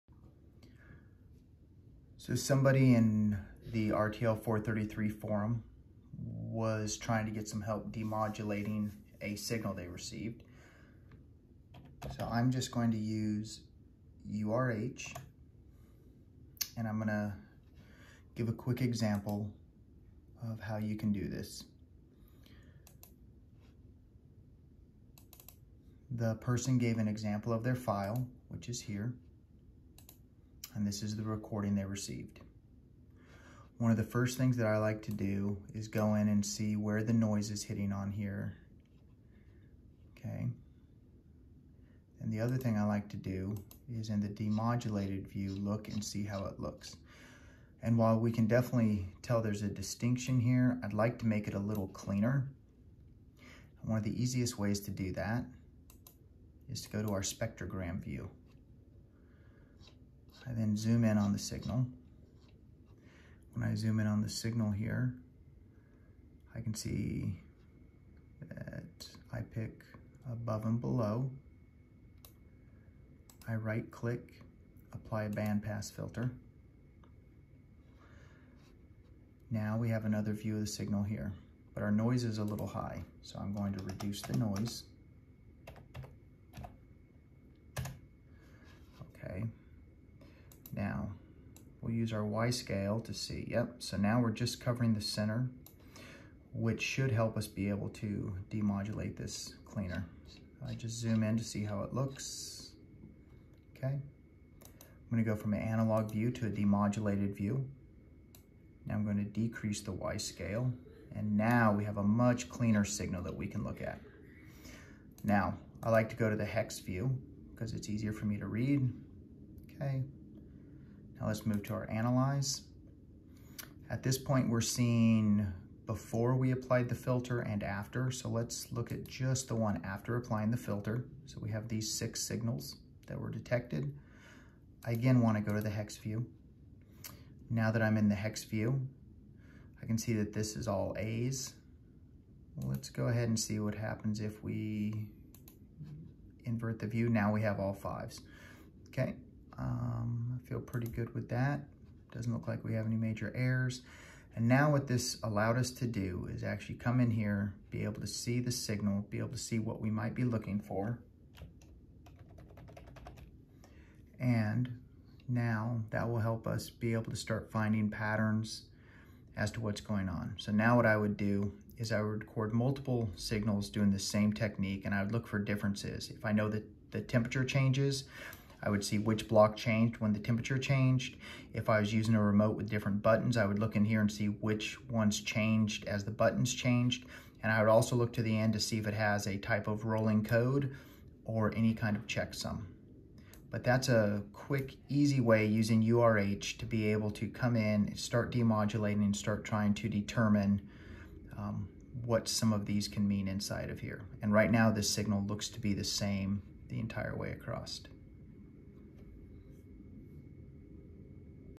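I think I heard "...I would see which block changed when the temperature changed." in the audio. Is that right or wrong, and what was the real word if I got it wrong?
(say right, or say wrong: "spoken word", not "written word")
right.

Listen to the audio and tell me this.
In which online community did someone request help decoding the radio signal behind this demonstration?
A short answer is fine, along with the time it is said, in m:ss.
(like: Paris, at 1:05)
RTL 433 forum, at 0:03.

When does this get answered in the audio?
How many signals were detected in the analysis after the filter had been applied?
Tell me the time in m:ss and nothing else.
2:11.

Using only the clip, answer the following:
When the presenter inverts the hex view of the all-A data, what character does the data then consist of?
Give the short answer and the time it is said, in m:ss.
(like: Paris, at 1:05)
5, at 2:27.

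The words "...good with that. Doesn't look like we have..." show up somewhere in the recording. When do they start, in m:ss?
2:30.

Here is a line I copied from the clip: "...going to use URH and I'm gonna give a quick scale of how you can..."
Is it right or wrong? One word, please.
wrong.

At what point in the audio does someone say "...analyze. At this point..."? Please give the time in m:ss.
2:01.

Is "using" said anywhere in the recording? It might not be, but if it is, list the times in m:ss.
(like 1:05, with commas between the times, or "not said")
3:01, 3:15.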